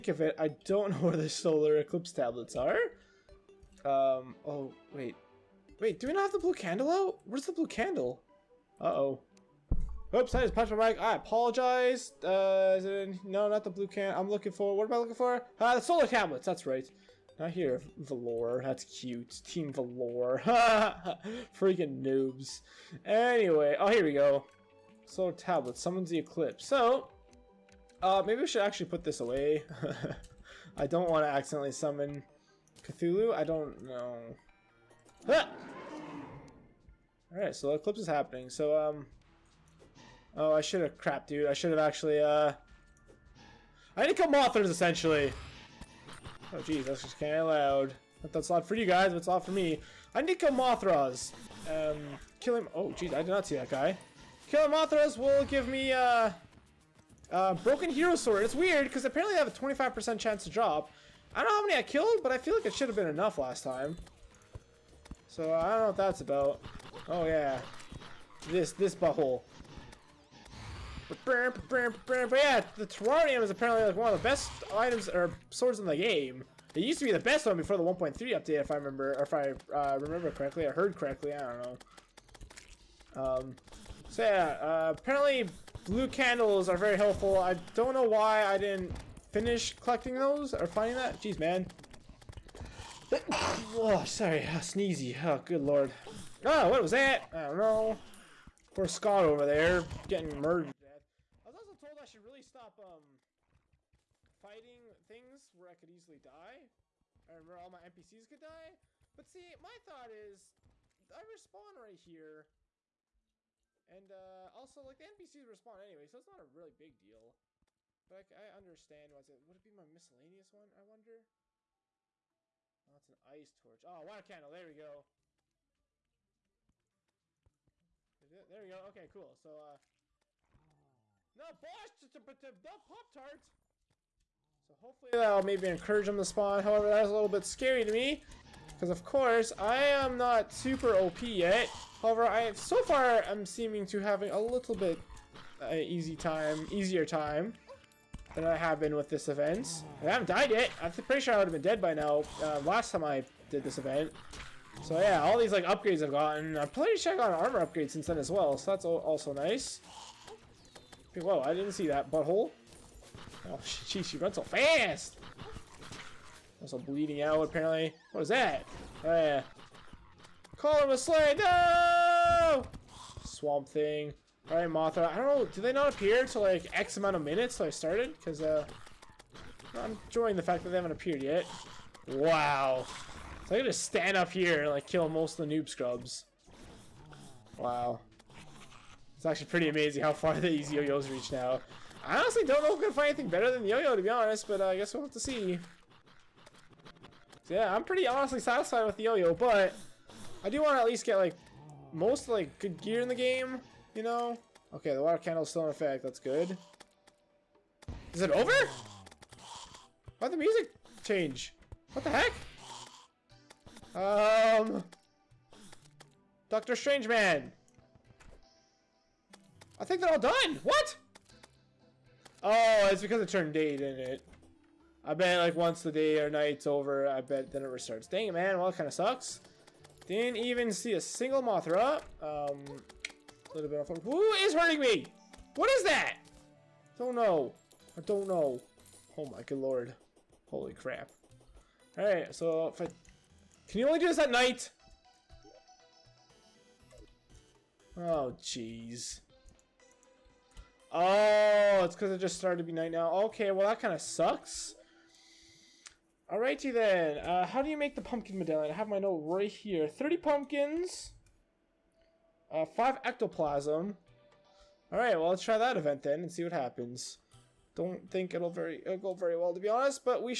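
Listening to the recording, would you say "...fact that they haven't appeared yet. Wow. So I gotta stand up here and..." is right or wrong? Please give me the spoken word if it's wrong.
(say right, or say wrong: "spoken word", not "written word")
right.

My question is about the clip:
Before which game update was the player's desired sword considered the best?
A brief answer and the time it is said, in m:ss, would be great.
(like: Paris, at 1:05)
1.3, at 1:17.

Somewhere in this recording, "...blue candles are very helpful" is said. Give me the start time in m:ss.
1:25.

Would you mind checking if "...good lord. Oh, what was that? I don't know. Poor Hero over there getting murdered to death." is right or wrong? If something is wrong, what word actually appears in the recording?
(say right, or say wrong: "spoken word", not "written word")
wrong: "Scott", not "Hero".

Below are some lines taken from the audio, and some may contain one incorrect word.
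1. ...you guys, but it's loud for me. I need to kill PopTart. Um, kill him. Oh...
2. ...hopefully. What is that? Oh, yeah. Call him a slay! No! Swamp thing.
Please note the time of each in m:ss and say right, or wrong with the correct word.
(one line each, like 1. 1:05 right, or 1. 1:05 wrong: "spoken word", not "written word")
1. 0:48 wrong: "Mothras", not "PopTart"
2. 2:47 wrong: "apparently", not "hopefully".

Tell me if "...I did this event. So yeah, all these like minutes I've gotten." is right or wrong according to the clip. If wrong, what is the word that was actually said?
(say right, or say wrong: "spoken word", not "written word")
wrong: "upgrades", not "minutes".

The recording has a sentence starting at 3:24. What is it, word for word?
Okay, the water candle's still in effect.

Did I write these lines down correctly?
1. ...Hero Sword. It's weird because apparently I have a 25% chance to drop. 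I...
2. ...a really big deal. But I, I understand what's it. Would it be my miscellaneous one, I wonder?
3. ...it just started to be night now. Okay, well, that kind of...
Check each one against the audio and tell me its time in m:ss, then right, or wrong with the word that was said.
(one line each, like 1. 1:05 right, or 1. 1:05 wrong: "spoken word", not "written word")
1. 0:57 right
2. 1:56 right
3. 4:12 right.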